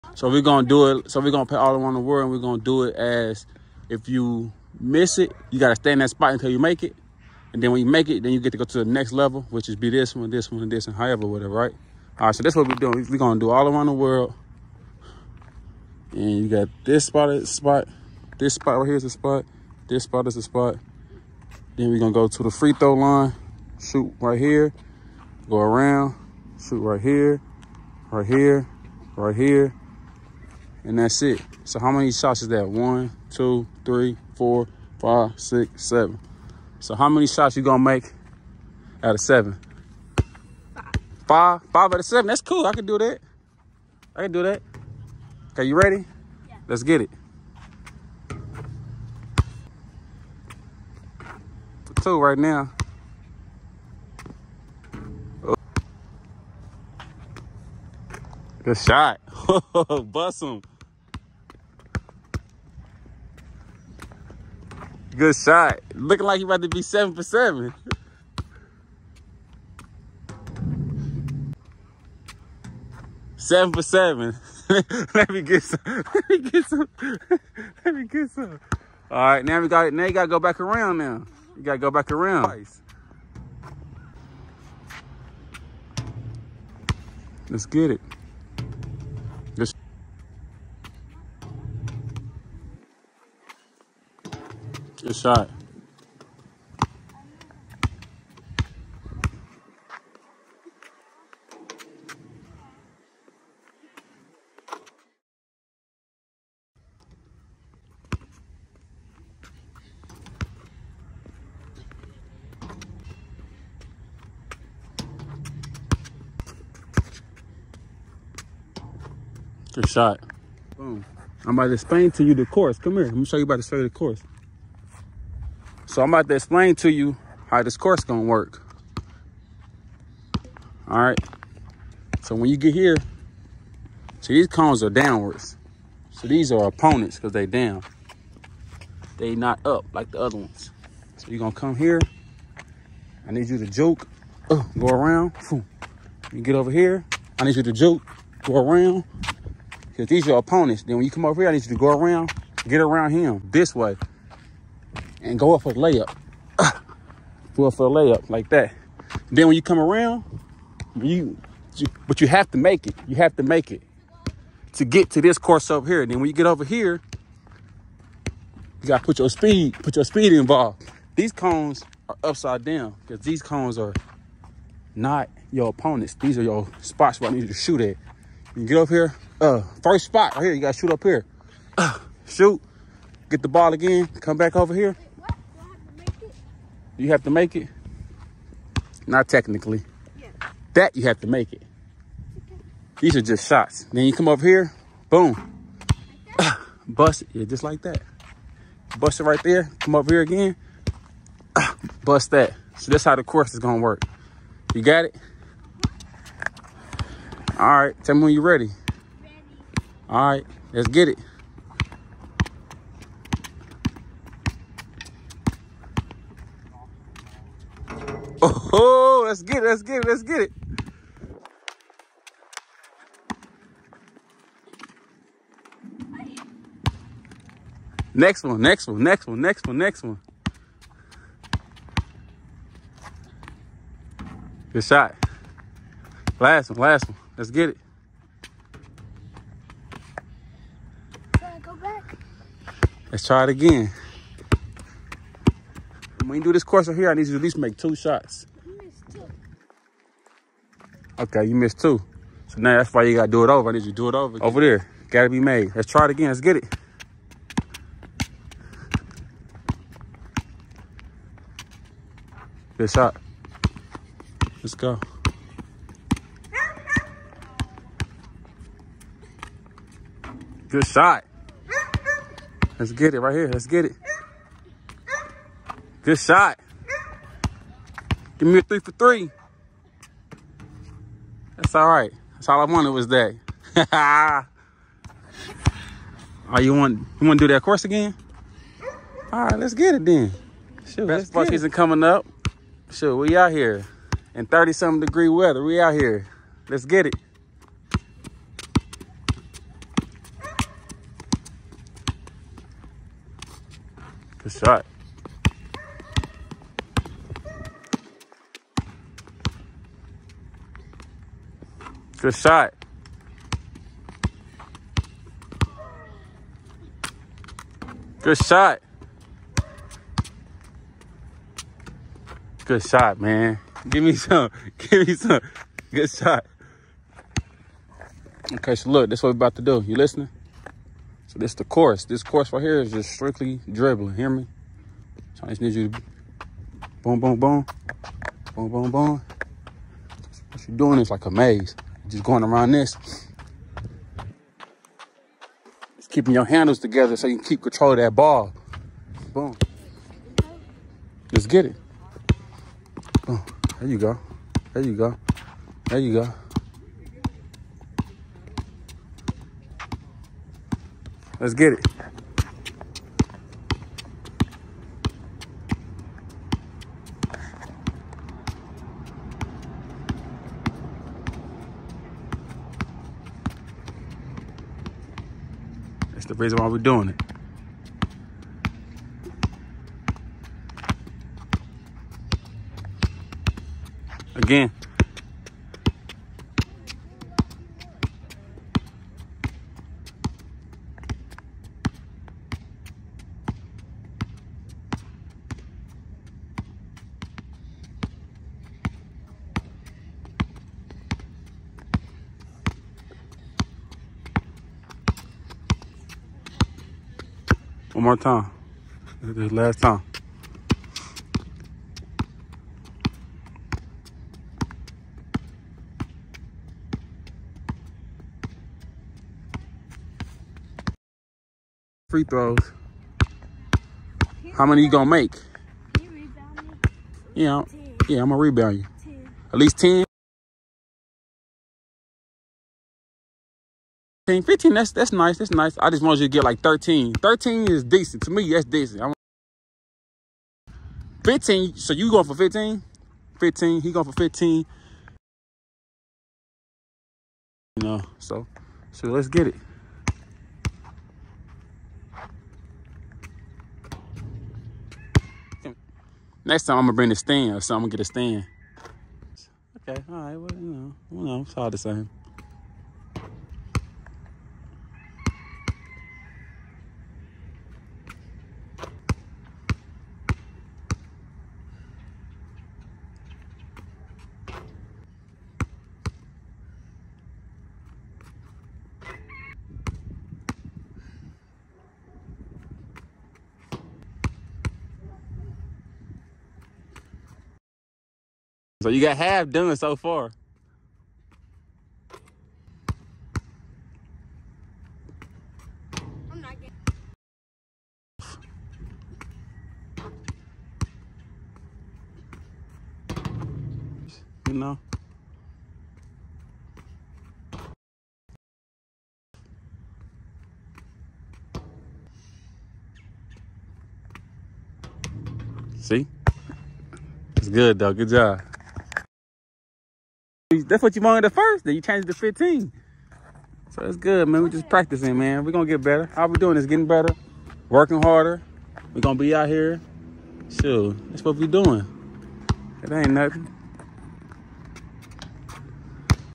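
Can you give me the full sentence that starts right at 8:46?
How we doing is getting better, working harder.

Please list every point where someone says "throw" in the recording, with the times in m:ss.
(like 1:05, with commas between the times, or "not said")
0:22, 7:02.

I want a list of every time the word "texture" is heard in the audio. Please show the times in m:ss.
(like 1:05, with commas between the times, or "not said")
not said.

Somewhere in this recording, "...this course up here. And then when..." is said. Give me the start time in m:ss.
2:45.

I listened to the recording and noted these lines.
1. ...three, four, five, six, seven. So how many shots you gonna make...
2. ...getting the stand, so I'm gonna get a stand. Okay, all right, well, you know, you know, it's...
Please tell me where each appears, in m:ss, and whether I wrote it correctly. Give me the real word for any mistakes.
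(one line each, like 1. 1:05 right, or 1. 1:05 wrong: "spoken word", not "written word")
1. 0:33 right
2. 7:36 wrong: "bring", not "getting".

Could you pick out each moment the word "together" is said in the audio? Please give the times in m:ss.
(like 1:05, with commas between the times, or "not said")
5:46.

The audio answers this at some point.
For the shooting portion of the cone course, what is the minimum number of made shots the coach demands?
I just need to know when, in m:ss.
4:07.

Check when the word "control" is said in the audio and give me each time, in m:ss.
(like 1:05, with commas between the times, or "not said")
5:47.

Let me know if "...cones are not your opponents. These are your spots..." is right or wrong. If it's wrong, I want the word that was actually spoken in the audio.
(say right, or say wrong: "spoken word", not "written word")
right.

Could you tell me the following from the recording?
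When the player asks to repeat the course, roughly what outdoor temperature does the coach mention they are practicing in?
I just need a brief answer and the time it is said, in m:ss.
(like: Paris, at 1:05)
30 something degrees, at 4:54.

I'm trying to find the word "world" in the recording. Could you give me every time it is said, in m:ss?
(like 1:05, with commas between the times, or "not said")
0:01, 0:13.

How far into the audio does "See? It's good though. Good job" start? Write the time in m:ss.
8:35.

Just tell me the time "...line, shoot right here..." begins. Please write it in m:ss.
0:22.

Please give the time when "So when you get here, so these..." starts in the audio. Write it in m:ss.
2:12.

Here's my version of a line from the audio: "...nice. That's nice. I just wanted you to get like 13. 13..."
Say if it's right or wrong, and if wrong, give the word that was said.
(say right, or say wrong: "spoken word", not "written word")
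right.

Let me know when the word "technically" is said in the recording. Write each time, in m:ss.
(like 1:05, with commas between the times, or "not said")
3:09.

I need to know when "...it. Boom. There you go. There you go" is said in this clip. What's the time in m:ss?
5:51.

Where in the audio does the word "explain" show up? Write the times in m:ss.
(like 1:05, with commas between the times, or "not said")
2:01, 2:06.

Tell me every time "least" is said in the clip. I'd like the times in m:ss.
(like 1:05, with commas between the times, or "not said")
4:07, 7:09.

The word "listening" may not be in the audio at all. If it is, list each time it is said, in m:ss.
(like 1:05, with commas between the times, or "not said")
5:29.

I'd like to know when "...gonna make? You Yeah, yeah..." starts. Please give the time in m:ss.
7:04.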